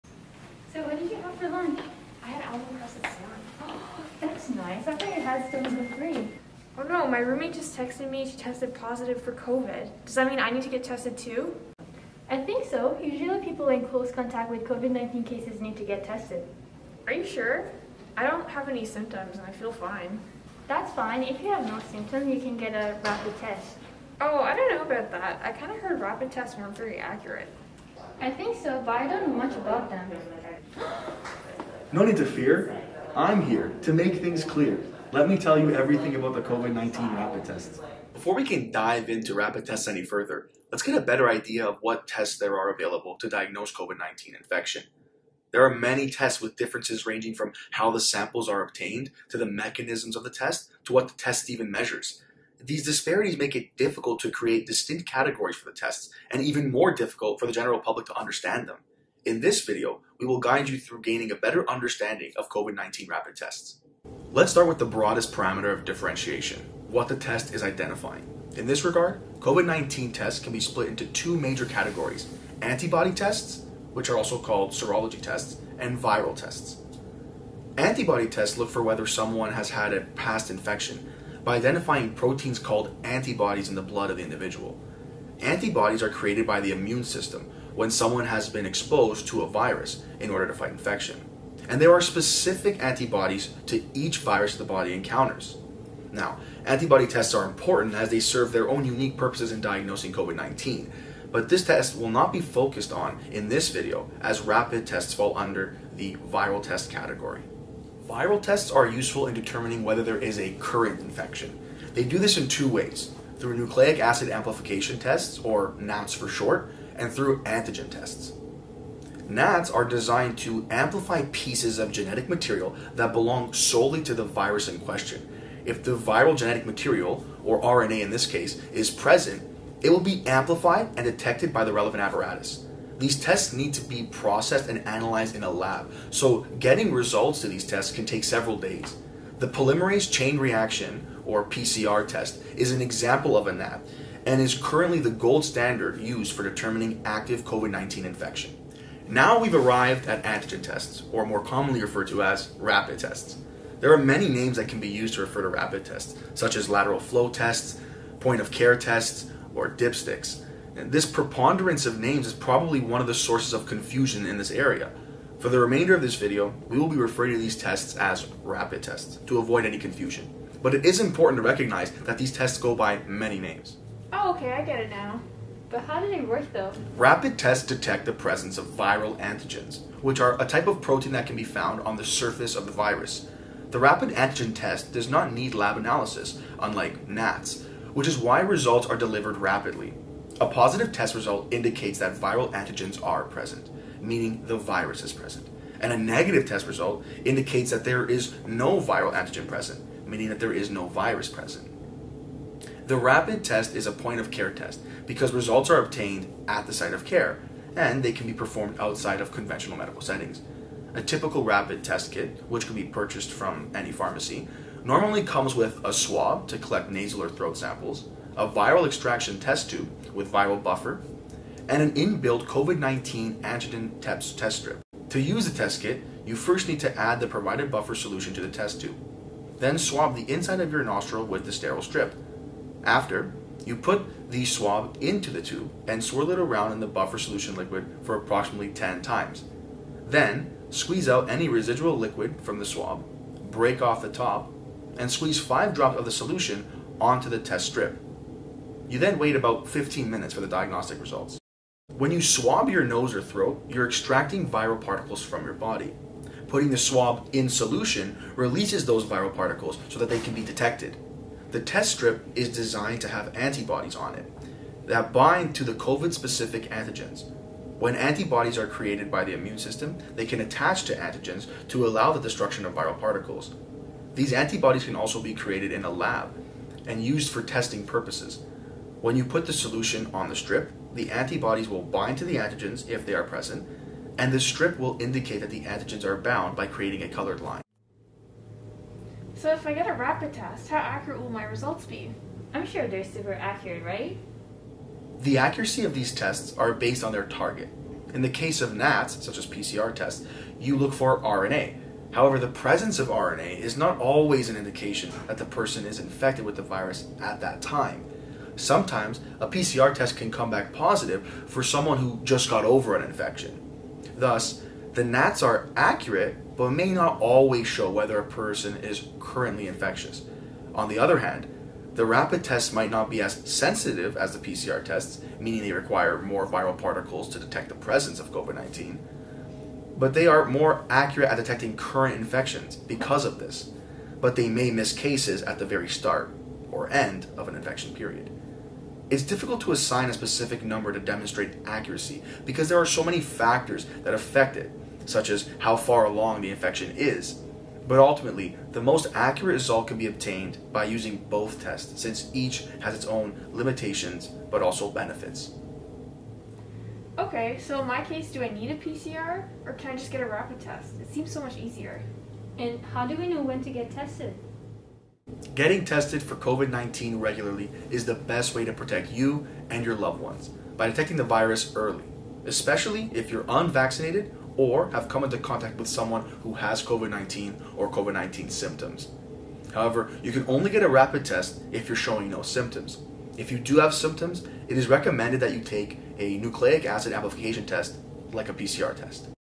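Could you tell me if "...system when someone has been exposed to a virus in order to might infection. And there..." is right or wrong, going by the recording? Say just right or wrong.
wrong.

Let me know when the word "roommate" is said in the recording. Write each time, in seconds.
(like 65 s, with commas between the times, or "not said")
7 s.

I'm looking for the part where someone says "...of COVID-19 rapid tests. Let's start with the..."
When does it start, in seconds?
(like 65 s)
62 s.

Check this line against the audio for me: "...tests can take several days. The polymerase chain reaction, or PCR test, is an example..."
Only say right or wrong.
right.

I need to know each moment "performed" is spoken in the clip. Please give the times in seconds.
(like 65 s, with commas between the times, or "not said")
208 s.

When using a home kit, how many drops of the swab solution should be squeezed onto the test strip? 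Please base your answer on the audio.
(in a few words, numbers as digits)
5.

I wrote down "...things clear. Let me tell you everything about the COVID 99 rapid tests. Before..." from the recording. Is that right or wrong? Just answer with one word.
wrong.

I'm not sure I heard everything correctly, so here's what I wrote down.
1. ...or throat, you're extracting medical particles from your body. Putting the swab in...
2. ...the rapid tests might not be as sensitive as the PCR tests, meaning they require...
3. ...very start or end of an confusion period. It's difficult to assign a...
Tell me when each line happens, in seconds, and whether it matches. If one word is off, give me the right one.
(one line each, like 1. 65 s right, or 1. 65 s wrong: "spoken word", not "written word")
1. 253 s wrong: "viral", not "medical"
2. 321 s right
3. 335 s wrong: "infection", not "confusion".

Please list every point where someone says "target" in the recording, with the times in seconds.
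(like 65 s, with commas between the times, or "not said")
297 s.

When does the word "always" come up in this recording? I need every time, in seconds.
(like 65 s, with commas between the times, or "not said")
303 s, 317 s.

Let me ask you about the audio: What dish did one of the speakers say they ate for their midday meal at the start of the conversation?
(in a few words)
almond crusted salmon.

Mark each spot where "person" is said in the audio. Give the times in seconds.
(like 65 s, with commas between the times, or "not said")
305 s, 318 s.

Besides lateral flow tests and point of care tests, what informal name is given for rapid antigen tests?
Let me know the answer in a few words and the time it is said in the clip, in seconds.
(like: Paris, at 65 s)
dipsticks, at 159 s.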